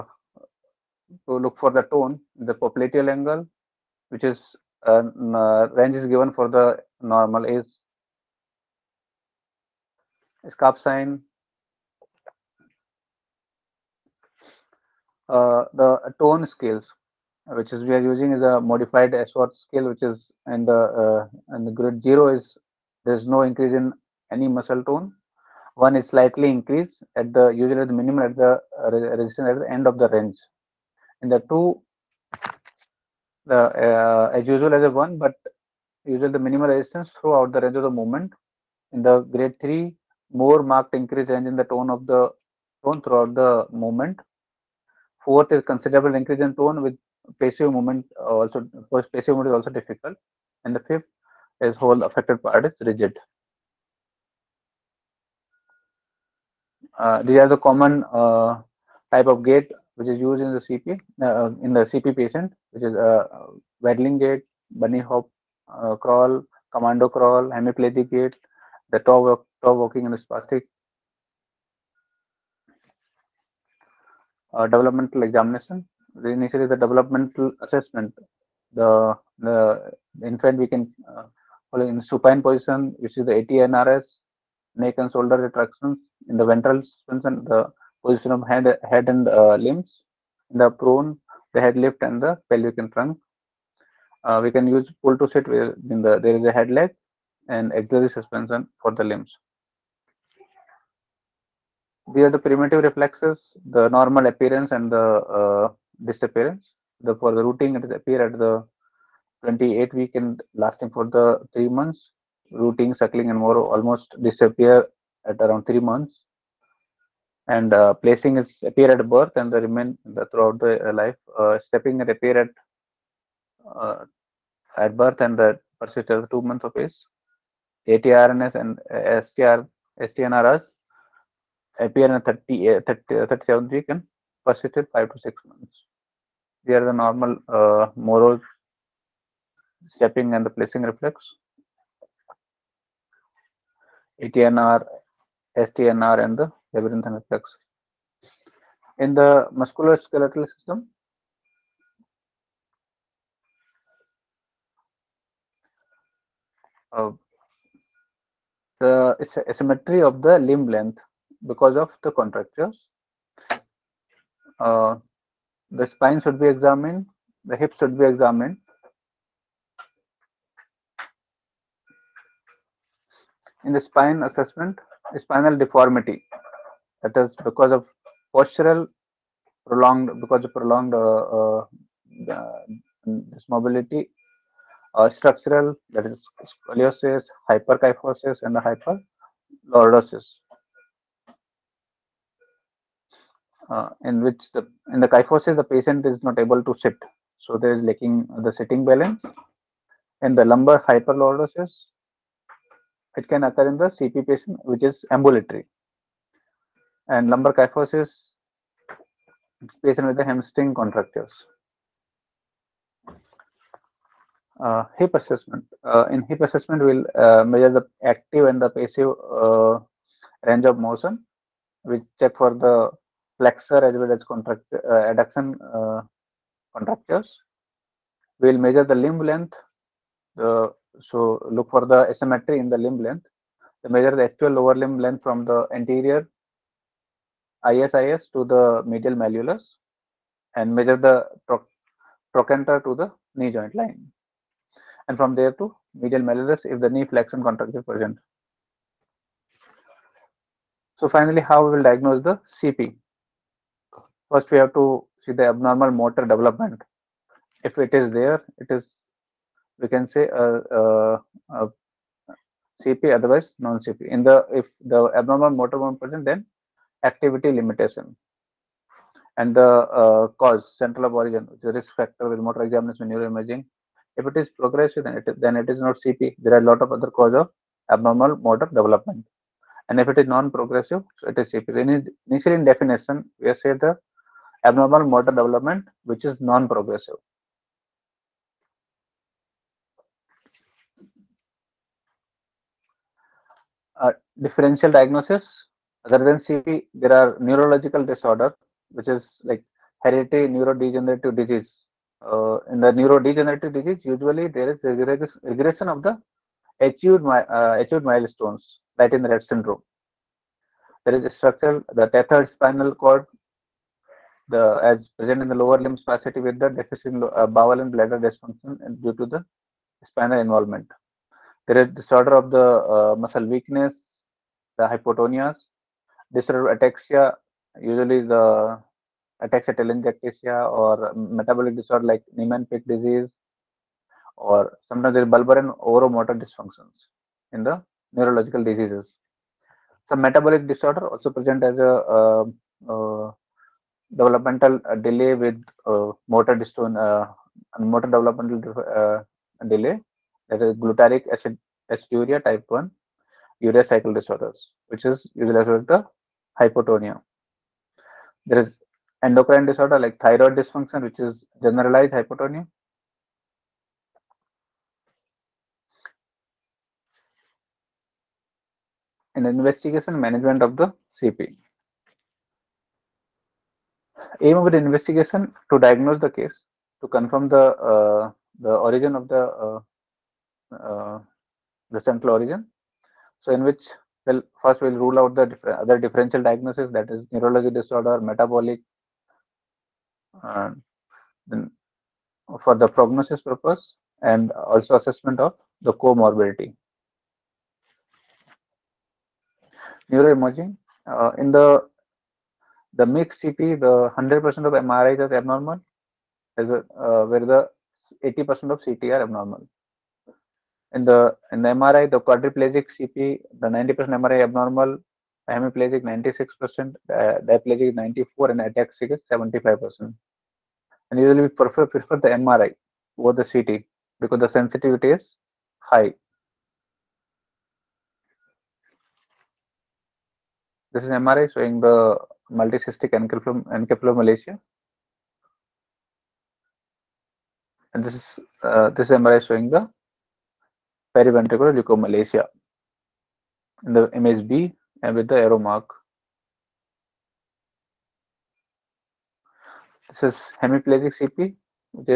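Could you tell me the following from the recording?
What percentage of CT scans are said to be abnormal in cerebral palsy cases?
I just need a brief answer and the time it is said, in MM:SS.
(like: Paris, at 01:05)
80%, at 06:48.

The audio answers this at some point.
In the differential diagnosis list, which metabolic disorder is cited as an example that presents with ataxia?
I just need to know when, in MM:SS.
05:32.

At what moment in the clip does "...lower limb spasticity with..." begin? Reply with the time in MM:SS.
05:15.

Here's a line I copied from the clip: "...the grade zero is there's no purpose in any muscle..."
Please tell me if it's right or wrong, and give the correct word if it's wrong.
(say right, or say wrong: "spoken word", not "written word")
wrong: "increase", not "purpose".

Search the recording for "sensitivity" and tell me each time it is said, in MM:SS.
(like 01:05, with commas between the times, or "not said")
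07:04.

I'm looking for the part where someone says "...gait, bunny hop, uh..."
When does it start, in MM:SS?
01:04.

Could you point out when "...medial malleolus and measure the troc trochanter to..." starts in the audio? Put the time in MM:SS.
03:58.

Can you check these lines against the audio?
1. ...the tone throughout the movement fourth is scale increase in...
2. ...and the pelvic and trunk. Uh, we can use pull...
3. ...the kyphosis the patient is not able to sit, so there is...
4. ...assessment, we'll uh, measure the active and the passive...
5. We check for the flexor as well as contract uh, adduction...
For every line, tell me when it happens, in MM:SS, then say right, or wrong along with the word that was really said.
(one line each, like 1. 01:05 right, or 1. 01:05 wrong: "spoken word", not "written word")
1. 00:42 wrong: "considerable", not "scale"
2. 01:32 right
3. 03:14 right
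4. 03:36 right
5. 03:41 right.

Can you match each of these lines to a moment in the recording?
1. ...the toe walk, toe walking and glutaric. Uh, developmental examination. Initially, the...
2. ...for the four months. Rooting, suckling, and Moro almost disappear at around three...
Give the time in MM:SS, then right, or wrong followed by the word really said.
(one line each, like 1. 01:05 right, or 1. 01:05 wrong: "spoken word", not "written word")
1. 01:08 wrong: "spastic", not "glutaric"
2. 01:50 wrong: "three", not "four".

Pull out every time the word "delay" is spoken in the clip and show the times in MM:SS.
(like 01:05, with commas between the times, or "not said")
05:45, 05:49.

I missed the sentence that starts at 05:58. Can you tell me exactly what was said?
There is endocrine disorder like thyroid dysfunction, which is generalized hypotonia.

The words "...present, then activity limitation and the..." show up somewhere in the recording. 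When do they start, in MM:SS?
04:25.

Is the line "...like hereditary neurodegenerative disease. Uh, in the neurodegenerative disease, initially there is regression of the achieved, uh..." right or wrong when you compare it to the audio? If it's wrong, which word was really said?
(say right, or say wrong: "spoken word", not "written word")
wrong: "usually", not "initially".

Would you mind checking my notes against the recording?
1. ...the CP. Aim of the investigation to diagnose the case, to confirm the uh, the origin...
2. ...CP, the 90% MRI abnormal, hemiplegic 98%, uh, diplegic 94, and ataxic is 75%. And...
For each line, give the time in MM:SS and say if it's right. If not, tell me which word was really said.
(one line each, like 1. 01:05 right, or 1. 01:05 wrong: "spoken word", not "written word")
1. 06:10 right
2. 06:52 wrong: "96", not "98".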